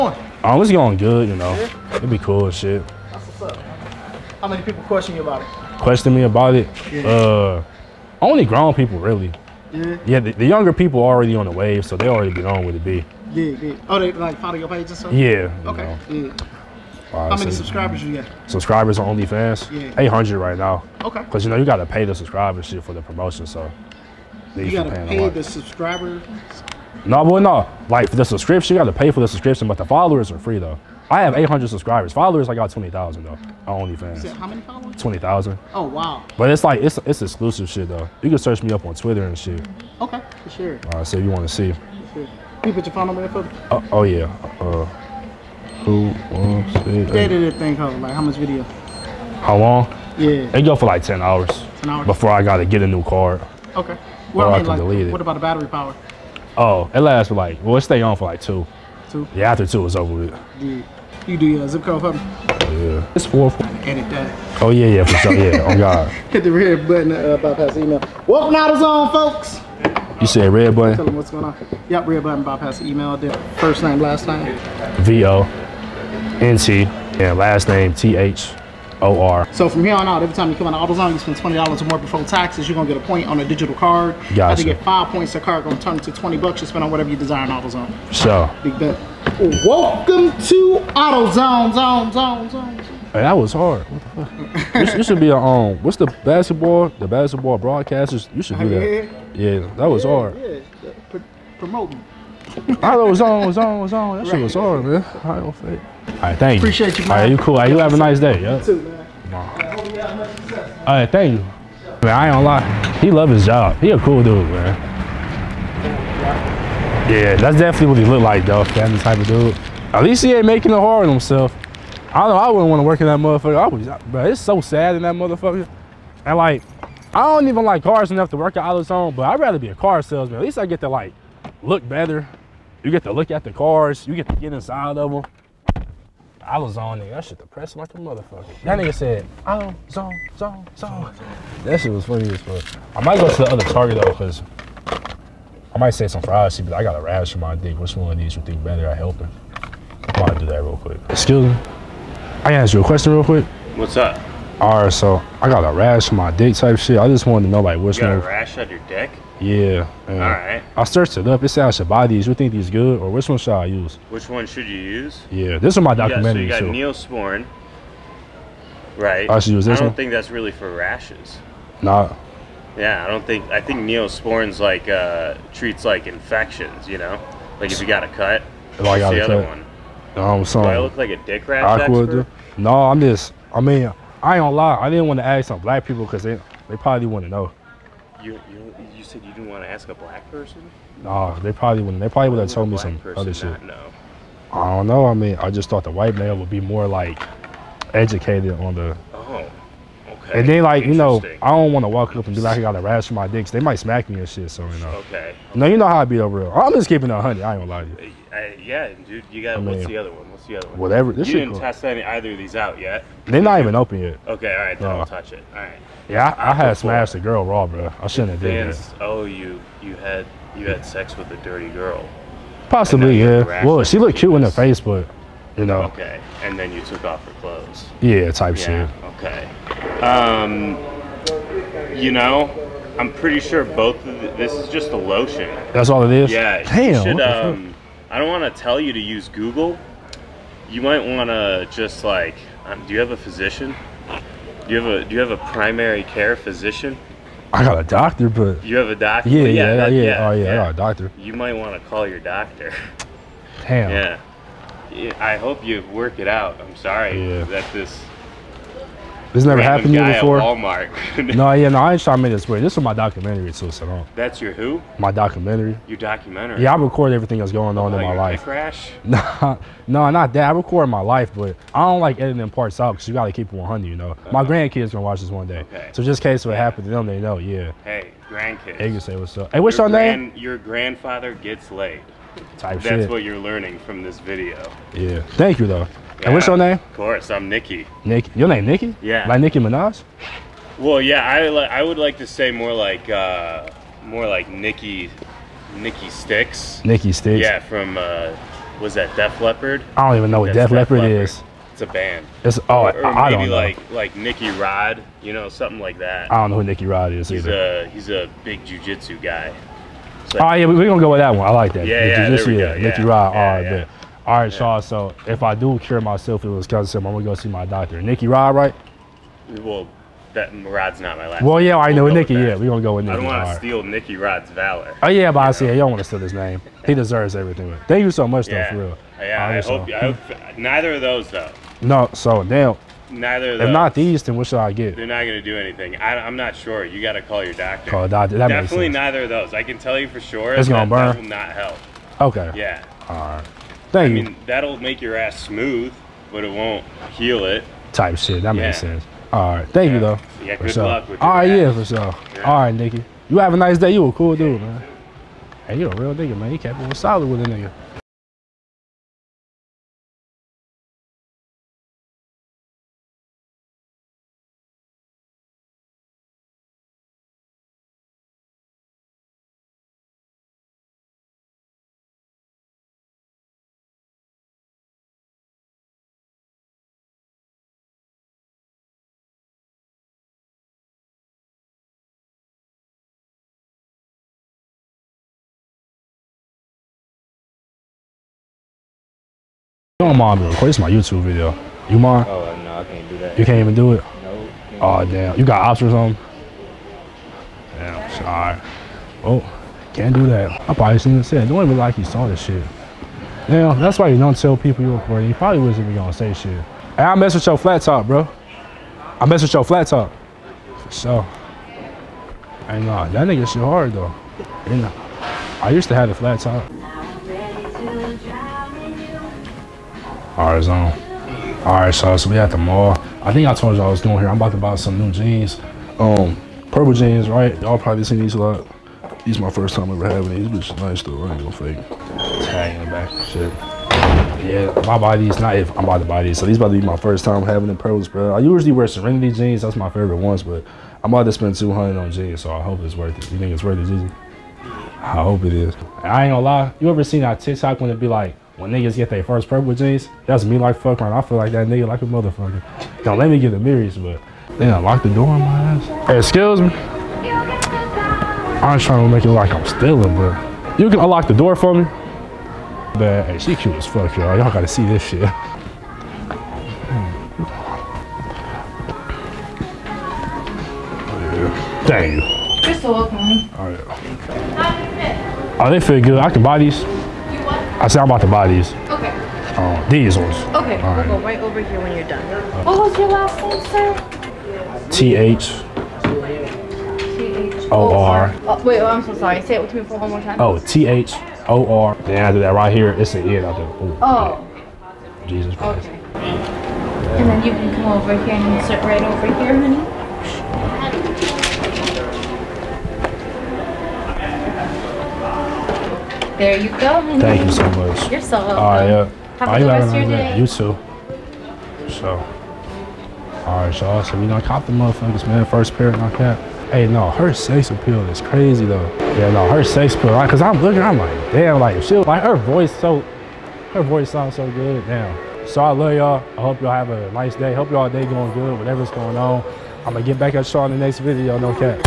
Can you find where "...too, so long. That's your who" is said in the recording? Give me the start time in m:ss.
4:23.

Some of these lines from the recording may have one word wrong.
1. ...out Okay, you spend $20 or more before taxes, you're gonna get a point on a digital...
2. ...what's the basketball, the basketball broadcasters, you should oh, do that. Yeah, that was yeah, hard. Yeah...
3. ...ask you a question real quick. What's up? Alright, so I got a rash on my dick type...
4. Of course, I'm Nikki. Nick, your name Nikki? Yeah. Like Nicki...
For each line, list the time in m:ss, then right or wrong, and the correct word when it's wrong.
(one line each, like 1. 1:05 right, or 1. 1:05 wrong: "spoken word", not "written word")
1. 1:20 wrong: "AutoZone", not "Okay"
2. 1:35 right
3. 2:32 right
4. 4:46 right.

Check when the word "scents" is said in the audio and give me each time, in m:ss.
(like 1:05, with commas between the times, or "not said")
not said.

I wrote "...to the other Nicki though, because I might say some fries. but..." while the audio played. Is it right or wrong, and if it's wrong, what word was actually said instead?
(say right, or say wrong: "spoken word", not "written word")
wrong: "Target", not "Nicki".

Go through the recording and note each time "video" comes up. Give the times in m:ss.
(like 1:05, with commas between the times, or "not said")
0:48, 4:44, 6:31, 8:50.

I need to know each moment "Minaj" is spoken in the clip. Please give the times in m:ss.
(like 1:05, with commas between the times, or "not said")
4:49.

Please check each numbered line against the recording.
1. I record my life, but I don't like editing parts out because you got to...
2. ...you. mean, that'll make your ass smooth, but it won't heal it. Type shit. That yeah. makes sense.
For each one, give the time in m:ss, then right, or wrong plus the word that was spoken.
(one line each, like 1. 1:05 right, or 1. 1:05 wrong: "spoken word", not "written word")
1. 4:30 right
2. 5:44 right.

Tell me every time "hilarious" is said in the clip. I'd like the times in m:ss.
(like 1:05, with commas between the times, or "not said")
not said.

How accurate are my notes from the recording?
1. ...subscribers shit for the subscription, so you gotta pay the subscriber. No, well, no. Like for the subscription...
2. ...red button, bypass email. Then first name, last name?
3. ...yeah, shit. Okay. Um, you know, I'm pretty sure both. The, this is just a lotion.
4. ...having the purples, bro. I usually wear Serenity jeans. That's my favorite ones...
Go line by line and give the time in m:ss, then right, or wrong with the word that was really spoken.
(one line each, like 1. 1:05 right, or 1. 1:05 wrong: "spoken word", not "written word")
1. 0:22 wrong: "promotion", not "subscription"
2. 1:12 right
3. 3:48 right
4. 7:17 right.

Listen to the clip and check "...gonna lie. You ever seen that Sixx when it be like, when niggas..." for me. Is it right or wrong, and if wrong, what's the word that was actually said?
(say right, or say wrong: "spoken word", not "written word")
wrong: "TikTok", not "Sixx".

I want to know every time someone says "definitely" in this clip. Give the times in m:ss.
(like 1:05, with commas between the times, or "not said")
1:57, 5:38.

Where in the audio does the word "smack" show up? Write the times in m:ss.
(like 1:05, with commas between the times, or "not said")
3:23.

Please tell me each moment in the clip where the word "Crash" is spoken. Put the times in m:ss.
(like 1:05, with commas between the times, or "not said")
4:28.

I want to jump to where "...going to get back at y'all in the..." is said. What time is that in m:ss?
8:49.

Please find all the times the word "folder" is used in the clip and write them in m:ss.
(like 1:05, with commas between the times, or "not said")
not said.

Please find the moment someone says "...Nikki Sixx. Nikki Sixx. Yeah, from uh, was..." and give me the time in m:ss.
4:55.